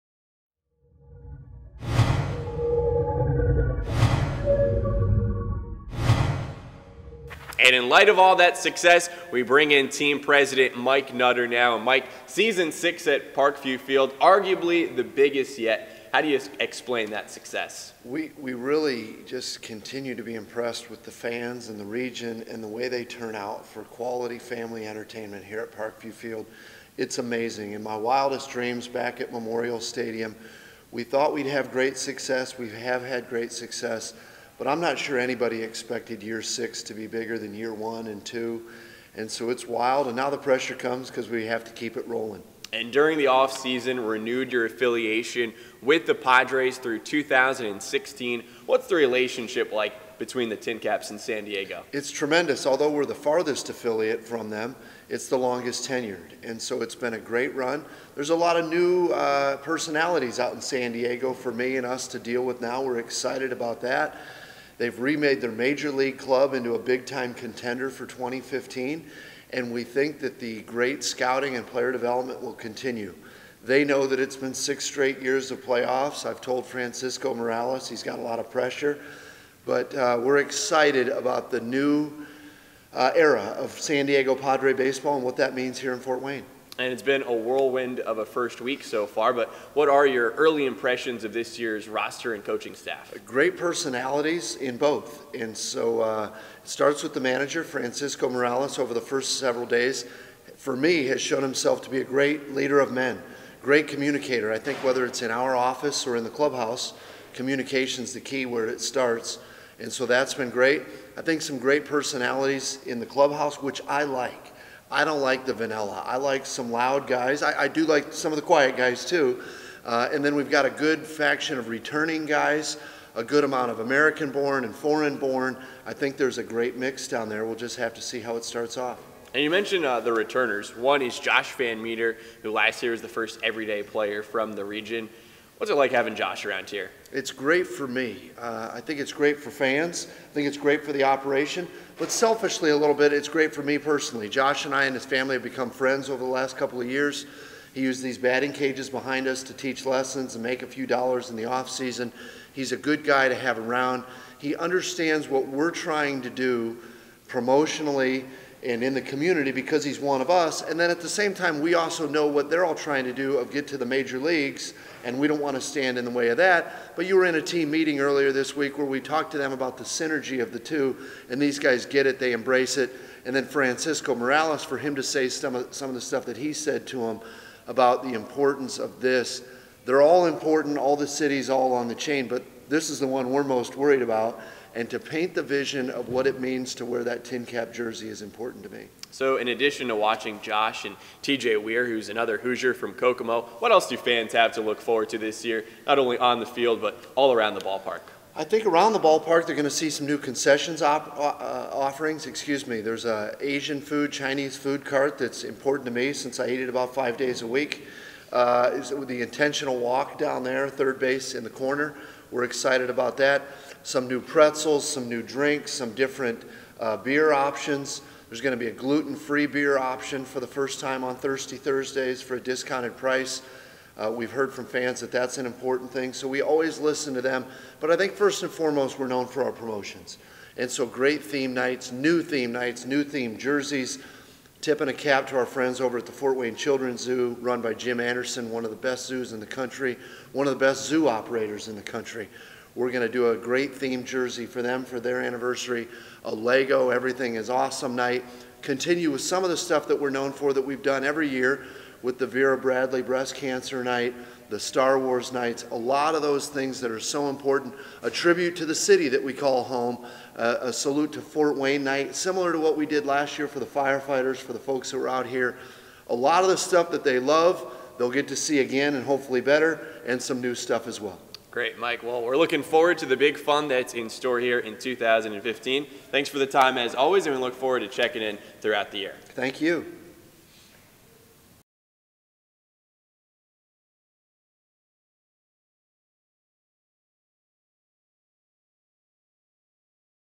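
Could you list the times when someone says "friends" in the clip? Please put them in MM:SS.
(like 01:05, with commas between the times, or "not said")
02:25, 03:55.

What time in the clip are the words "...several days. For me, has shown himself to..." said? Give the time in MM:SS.
01:39.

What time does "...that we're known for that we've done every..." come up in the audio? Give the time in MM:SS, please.
04:09.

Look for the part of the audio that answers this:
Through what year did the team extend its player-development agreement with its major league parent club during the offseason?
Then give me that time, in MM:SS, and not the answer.
00:46.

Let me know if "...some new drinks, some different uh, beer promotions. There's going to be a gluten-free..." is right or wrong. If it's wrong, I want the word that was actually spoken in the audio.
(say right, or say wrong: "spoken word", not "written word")
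wrong: "options", not "promotions".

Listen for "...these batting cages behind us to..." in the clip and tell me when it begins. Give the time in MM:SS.
02:28.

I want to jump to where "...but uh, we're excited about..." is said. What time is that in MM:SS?
01:19.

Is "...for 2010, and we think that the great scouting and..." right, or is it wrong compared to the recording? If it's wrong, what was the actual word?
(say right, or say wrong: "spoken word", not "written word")
wrong: "2015", not "2010".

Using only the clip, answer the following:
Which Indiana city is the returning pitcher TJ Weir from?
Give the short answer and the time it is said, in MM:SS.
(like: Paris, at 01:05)
Kokomo, at 03:12.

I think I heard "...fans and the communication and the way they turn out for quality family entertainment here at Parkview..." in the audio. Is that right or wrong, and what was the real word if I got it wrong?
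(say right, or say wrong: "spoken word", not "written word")
wrong: "region", not "communication".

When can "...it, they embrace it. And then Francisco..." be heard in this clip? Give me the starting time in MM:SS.
02:52.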